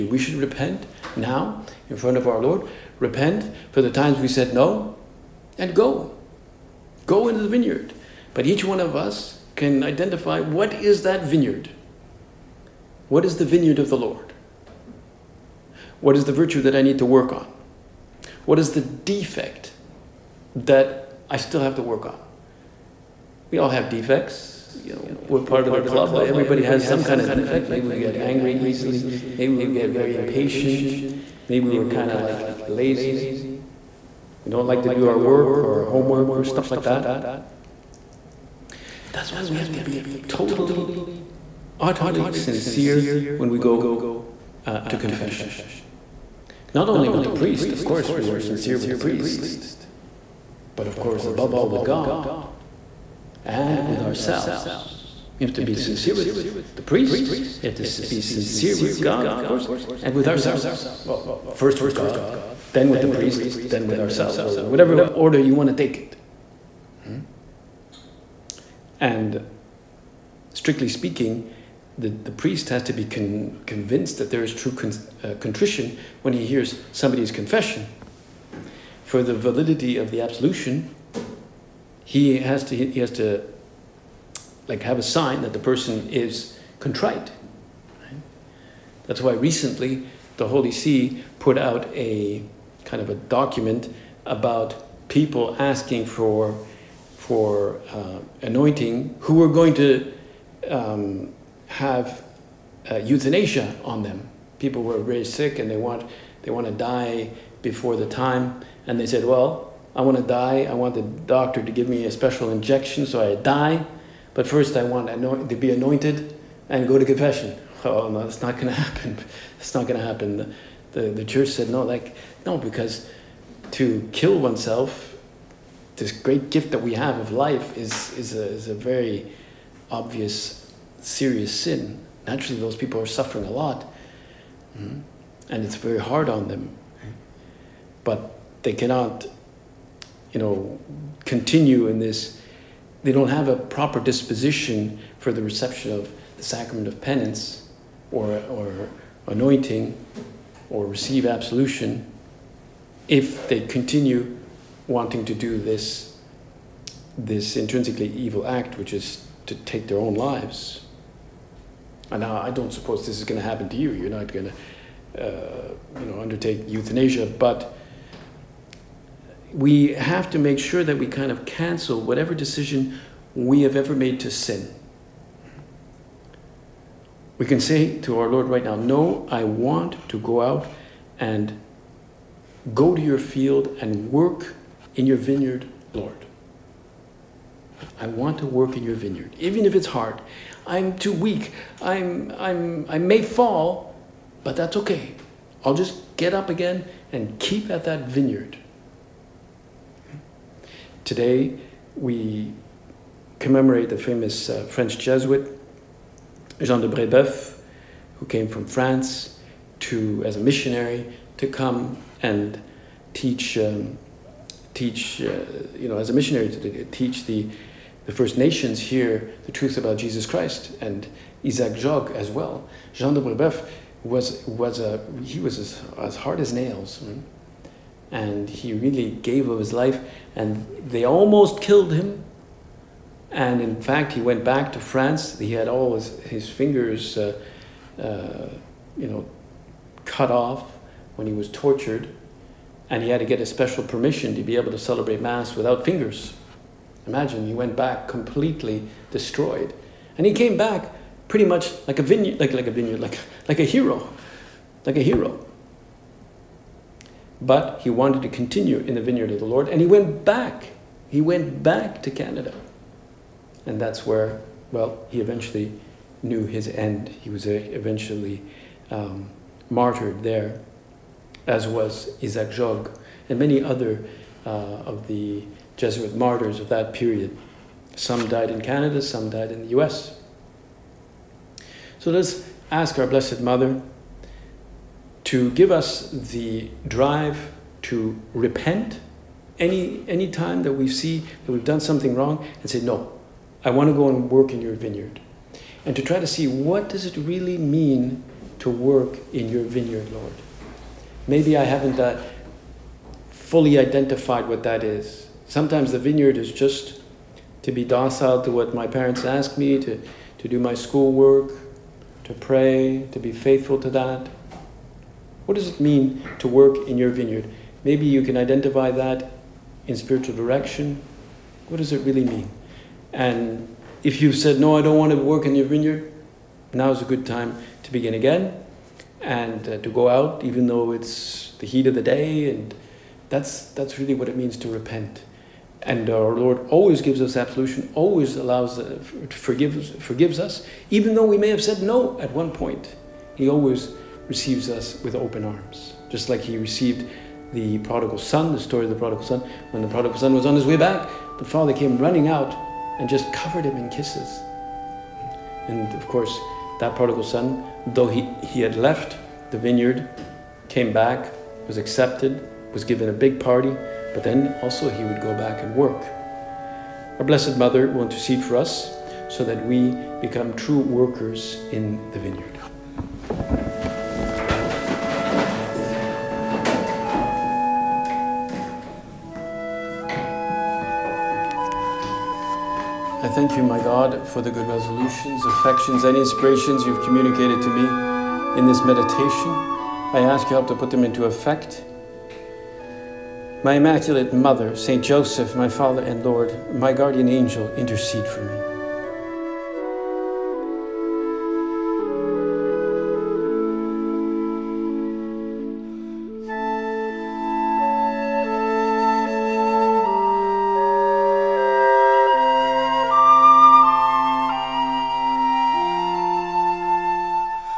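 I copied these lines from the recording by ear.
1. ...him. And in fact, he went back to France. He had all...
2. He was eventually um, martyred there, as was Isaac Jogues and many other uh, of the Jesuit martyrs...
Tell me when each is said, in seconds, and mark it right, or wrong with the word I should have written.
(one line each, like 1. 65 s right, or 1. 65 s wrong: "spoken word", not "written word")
1. 231 s right
2. 267 s right.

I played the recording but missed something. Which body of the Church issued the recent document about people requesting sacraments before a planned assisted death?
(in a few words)
The Holy See.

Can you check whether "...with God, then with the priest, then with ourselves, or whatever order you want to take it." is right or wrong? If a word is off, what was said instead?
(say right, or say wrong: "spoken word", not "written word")
right.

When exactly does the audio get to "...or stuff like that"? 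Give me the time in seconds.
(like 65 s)
36 s.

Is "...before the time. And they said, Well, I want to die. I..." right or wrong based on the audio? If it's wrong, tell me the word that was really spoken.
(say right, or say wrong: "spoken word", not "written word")
right.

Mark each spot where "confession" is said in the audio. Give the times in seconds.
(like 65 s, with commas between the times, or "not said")
44 s, 77 s, 117 s.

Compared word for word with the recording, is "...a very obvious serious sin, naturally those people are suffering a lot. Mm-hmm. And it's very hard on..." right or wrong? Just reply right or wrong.
right.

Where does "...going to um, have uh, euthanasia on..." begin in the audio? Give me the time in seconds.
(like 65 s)
99 s.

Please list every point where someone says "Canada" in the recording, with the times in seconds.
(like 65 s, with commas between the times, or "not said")
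262 s, 278 s.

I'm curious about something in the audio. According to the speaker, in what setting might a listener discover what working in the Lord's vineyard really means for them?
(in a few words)
Spiritual direction.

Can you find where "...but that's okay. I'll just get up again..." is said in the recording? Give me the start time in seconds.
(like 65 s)
194 s.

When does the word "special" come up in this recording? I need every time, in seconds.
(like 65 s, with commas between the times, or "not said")
112 s, 243 s.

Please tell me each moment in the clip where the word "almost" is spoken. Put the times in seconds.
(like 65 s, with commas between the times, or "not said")
231 s.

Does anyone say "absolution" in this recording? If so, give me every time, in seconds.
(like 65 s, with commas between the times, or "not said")
80 s, 151 s, 337 s.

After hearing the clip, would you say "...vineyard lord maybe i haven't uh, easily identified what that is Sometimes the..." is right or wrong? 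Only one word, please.
wrong.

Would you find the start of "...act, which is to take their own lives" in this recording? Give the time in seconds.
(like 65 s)
158 s.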